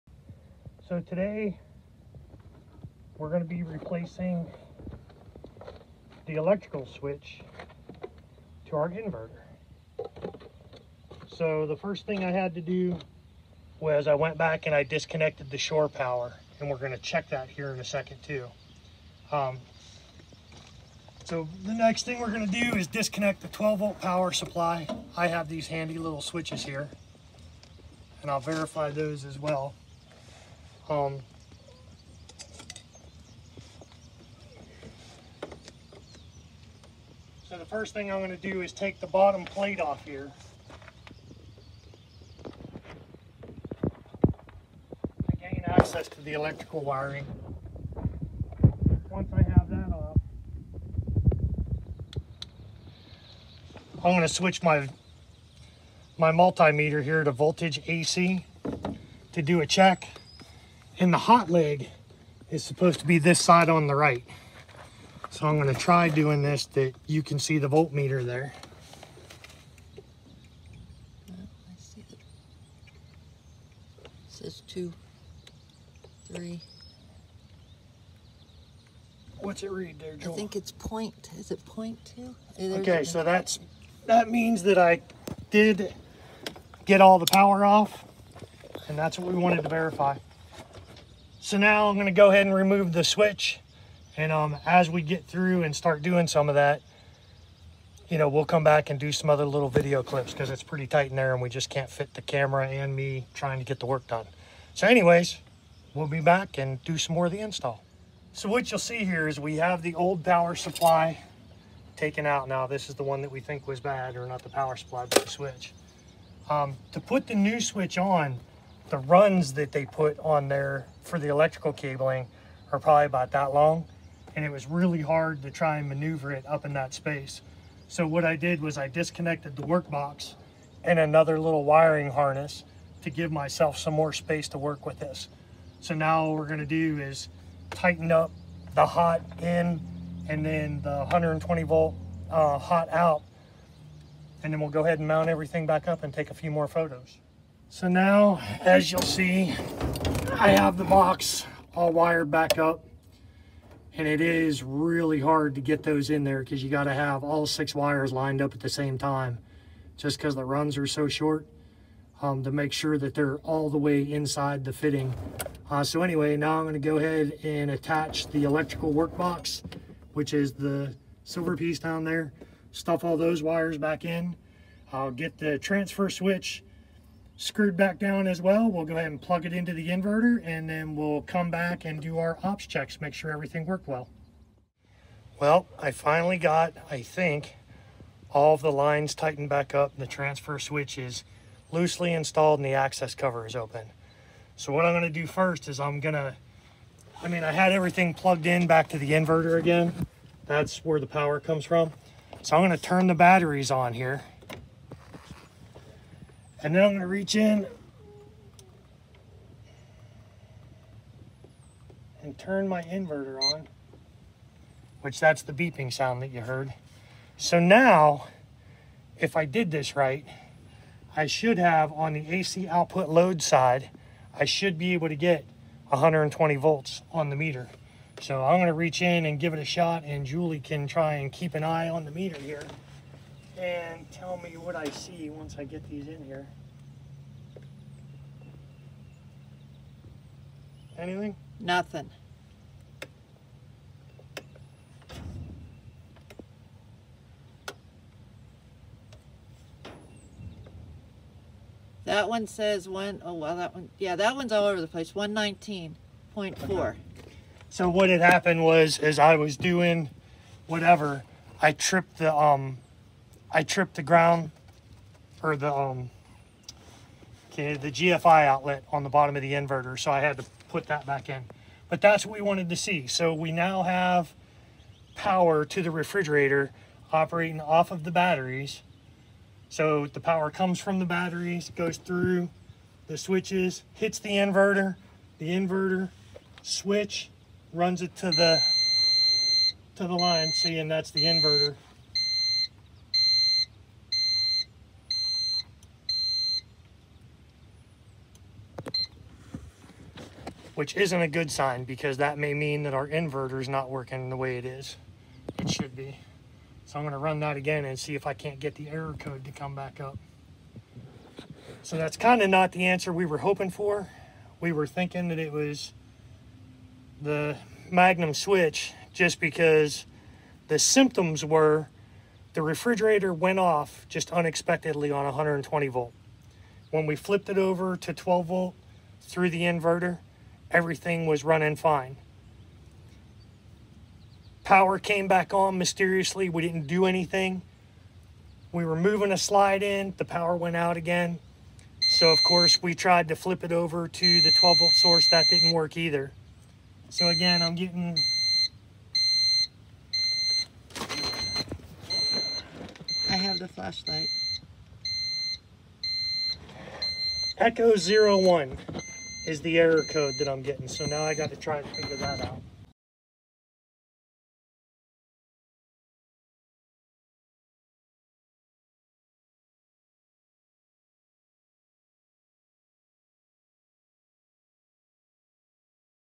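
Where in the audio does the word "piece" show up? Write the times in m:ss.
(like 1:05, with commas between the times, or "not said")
2:51.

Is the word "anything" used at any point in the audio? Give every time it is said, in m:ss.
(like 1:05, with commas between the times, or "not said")
4:00, 5:37.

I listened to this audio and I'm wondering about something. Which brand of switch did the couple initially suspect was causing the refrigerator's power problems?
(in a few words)
Magnum.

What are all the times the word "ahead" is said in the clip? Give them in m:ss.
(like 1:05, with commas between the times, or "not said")
1:32, 2:24, 2:46, 2:58.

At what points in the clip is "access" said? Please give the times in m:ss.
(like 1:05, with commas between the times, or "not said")
0:45, 3:12.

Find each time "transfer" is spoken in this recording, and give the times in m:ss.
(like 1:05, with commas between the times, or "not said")
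2:55, 3:10.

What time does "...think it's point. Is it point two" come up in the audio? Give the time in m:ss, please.
1:20.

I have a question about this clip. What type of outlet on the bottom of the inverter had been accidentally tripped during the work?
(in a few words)
GFI outlet.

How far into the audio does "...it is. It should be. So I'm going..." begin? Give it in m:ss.
5:04.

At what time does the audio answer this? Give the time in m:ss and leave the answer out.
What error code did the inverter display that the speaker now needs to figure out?
5:57.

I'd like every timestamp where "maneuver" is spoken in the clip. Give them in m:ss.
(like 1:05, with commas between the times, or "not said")
2:05.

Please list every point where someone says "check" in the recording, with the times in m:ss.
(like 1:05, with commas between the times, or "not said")
0:16, 0:59, 3:02.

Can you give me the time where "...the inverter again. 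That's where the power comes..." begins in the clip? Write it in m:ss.
3:18.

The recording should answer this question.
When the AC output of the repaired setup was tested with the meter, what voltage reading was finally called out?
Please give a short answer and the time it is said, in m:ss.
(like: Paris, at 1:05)
119.4, at 4:15.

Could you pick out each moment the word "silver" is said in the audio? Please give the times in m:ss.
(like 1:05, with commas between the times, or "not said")
2:51.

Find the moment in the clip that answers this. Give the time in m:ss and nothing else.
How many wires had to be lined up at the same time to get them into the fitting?
2:37.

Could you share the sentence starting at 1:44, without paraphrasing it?
So anyways, we'll be back and do some more of the install.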